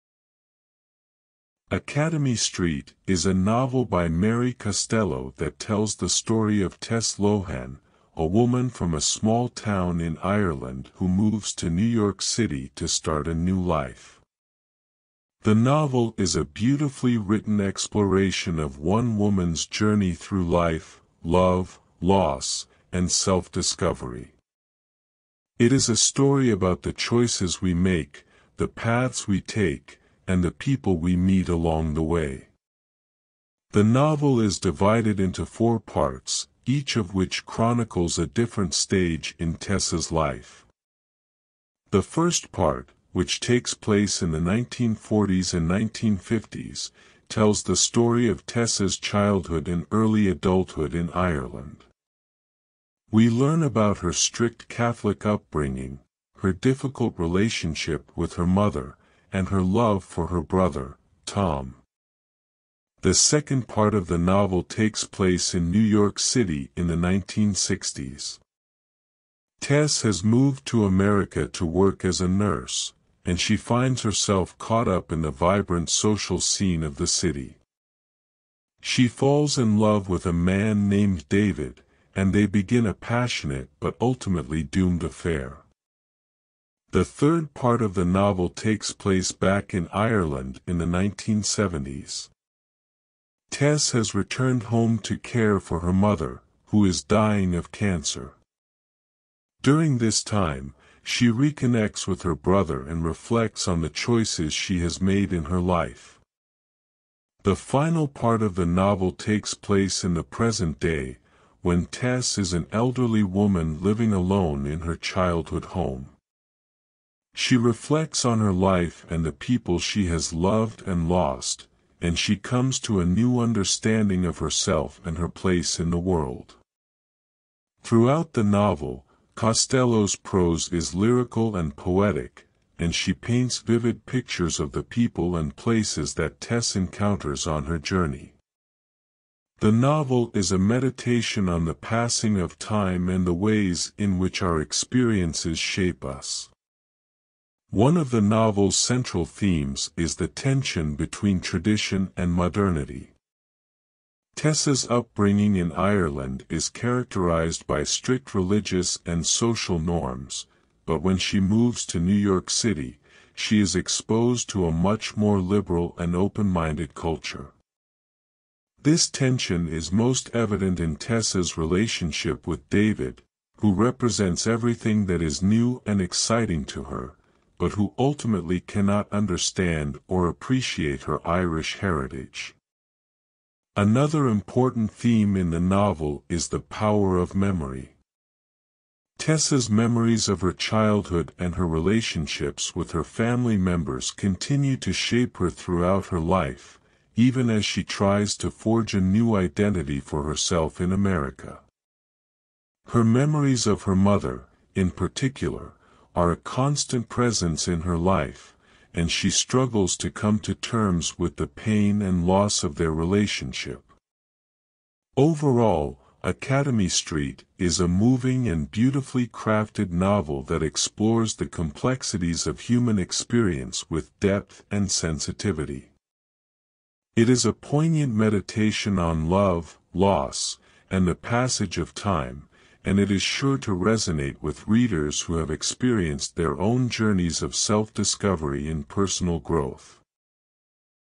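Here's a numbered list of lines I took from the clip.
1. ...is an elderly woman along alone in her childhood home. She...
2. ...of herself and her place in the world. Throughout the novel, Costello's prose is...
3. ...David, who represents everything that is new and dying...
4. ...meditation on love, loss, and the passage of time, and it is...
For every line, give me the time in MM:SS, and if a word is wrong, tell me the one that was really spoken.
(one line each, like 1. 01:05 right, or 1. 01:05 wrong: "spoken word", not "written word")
1. 01:52 wrong: "living", not "along"
2. 02:04 right
3. 02:52 wrong: "exciting", not "dying"
4. 03:48 right.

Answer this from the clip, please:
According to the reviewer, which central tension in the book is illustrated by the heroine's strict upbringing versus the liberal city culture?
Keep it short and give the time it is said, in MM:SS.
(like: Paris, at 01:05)
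Tradition and modernity, at 02:31.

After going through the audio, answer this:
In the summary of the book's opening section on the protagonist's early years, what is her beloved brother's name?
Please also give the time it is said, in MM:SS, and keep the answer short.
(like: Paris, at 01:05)
Tom, at 01:01.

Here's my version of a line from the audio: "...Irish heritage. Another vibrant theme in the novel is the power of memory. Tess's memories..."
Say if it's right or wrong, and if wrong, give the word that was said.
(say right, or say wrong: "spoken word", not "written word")
wrong: "important", not "vibrant".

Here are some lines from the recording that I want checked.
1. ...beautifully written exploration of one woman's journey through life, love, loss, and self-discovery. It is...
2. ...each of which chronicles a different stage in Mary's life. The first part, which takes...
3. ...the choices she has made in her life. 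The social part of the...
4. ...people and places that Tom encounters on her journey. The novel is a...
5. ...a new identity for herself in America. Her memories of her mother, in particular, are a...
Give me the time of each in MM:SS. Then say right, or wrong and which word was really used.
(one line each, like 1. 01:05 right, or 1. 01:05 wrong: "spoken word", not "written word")
1. 00:16 right
2. 00:36 wrong: "Tess", not "Mary"
3. 01:43 wrong: "final", not "social"
4. 02:14 wrong: "Tess", not "Tom"
5. 03:18 right.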